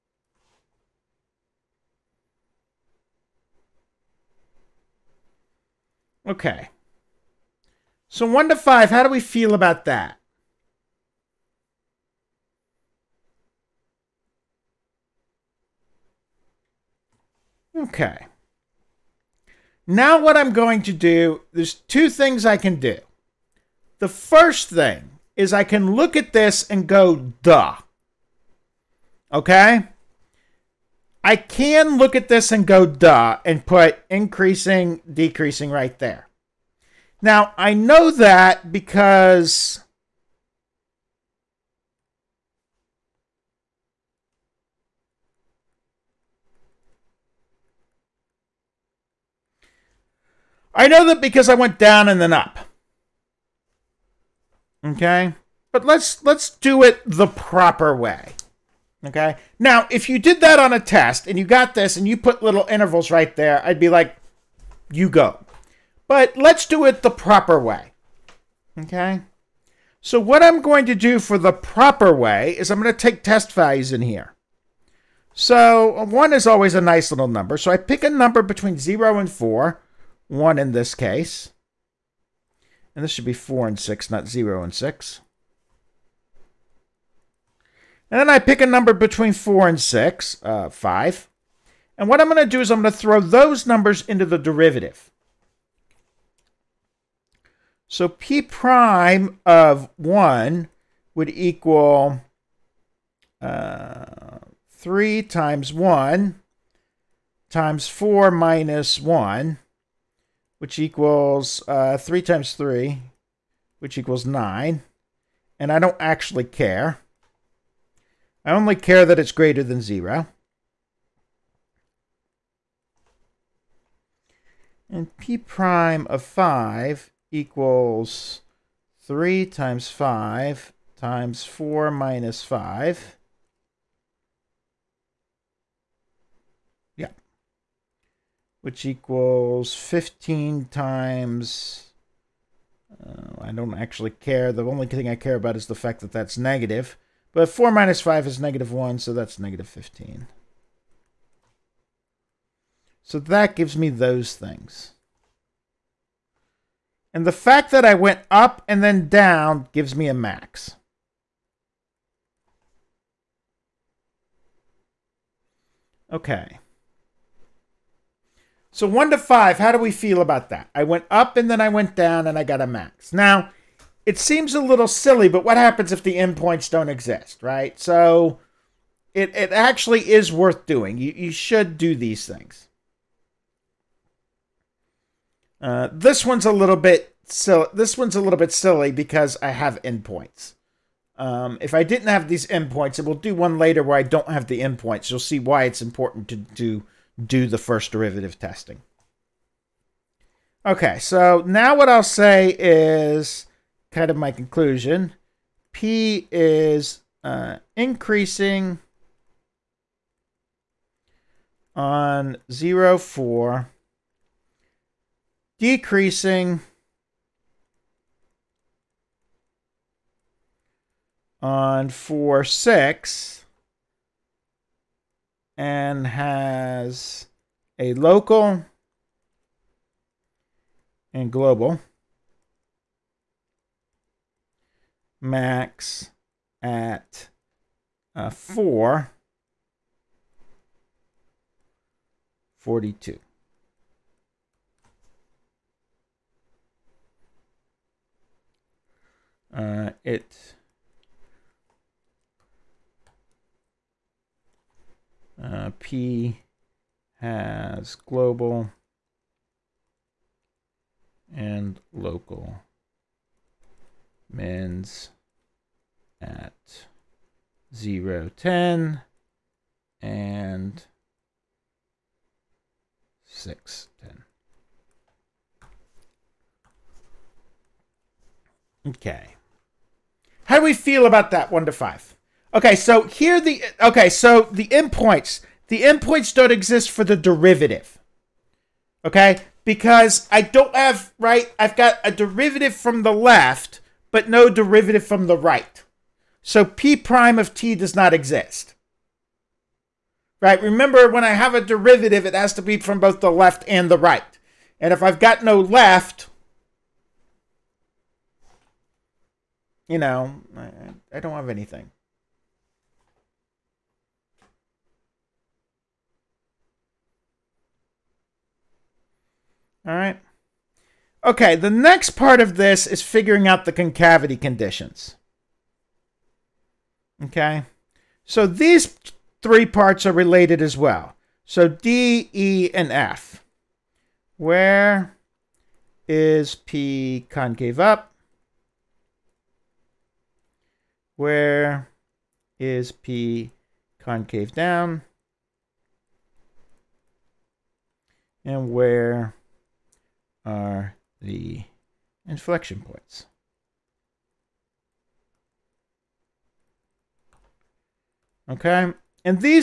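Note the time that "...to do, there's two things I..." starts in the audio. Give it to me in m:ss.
0:20.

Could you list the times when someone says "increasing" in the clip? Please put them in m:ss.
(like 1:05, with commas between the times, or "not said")
0:34, 3:27.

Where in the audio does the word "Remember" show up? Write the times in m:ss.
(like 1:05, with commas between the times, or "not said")
5:00.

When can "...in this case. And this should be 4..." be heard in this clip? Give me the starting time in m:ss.
1:20.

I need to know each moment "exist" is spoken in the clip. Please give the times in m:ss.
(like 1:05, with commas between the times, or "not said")
2:56, 4:46, 4:58.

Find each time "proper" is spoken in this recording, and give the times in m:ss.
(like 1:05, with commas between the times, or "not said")
0:57, 1:07, 1:11.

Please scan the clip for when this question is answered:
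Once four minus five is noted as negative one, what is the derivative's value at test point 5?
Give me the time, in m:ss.
2:29.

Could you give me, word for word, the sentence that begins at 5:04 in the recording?
And if I've got no left, you know, I, I don't have anything.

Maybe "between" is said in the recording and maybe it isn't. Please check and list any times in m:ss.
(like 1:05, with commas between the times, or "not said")
1:18, 1:28.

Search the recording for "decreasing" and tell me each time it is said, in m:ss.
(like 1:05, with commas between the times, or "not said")
0:35, 3:35.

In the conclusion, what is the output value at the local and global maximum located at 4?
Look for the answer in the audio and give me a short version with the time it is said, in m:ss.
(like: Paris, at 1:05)
42, at 4:02.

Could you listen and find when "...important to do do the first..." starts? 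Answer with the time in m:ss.
3:15.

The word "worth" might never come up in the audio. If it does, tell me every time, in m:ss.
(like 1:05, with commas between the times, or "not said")
3:00.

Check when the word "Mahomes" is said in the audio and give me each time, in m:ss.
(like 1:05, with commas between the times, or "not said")
not said.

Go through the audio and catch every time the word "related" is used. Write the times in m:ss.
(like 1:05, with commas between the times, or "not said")
5:30.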